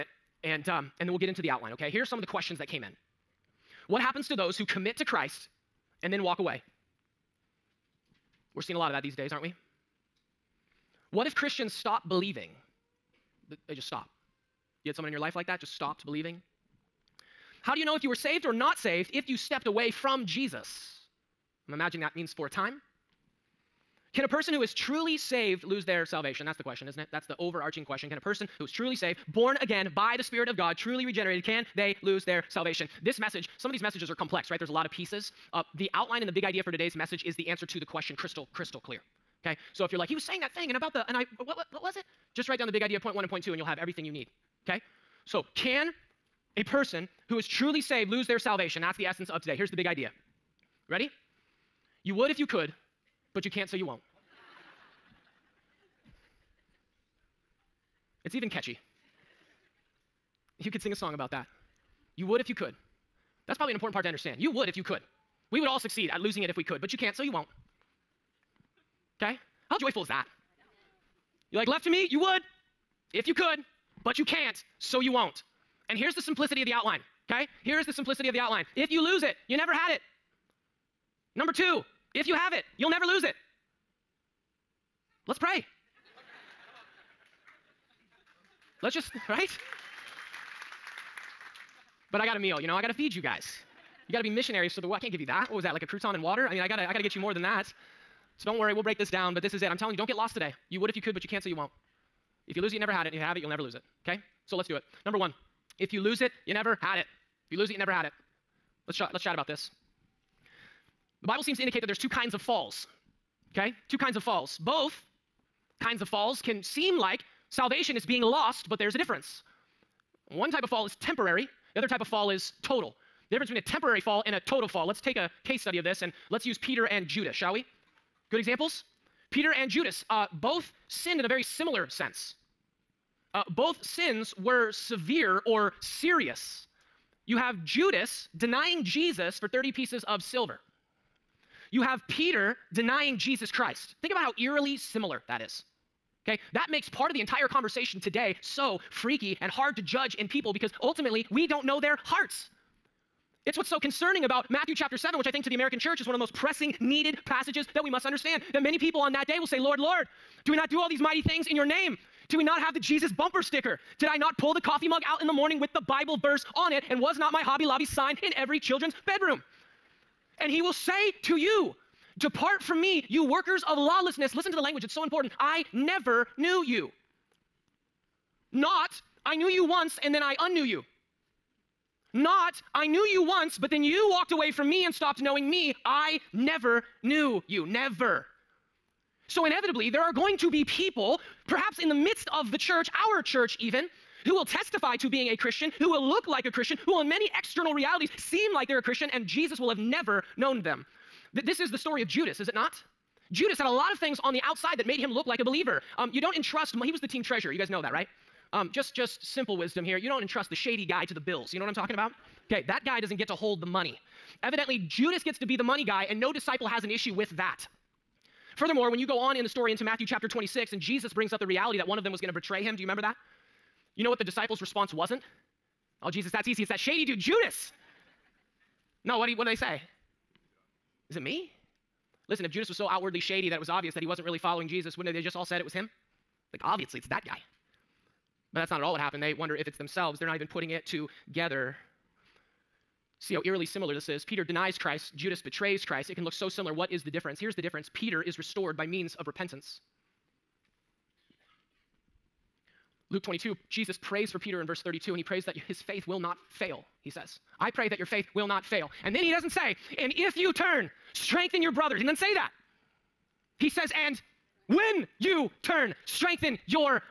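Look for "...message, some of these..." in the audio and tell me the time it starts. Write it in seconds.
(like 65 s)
33 s.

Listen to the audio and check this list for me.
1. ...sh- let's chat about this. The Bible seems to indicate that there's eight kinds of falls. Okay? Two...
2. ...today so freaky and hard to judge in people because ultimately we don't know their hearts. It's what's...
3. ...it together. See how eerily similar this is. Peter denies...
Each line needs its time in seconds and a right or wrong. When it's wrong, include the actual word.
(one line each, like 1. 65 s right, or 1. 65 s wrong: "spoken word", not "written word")
1. 108 s wrong: "two", not "eight"
2. 147 s right
3. 240 s right.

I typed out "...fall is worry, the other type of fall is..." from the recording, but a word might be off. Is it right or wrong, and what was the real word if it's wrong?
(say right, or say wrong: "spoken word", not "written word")
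wrong: "temporary", not "worry".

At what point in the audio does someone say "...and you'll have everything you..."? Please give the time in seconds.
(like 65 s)
43 s.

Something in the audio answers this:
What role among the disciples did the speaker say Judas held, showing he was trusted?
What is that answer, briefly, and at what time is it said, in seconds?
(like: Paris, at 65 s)
Team treasurer, at 207 s.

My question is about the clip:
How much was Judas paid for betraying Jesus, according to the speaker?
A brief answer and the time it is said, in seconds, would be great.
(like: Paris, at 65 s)
30 pieces of silver, at 139 s.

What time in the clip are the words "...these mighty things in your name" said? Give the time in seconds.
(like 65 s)
160 s.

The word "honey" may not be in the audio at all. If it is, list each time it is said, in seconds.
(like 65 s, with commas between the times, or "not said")
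not said.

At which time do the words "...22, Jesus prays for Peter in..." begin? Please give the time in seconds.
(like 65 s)
253 s.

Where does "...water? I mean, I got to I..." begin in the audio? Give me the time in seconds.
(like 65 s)
96 s.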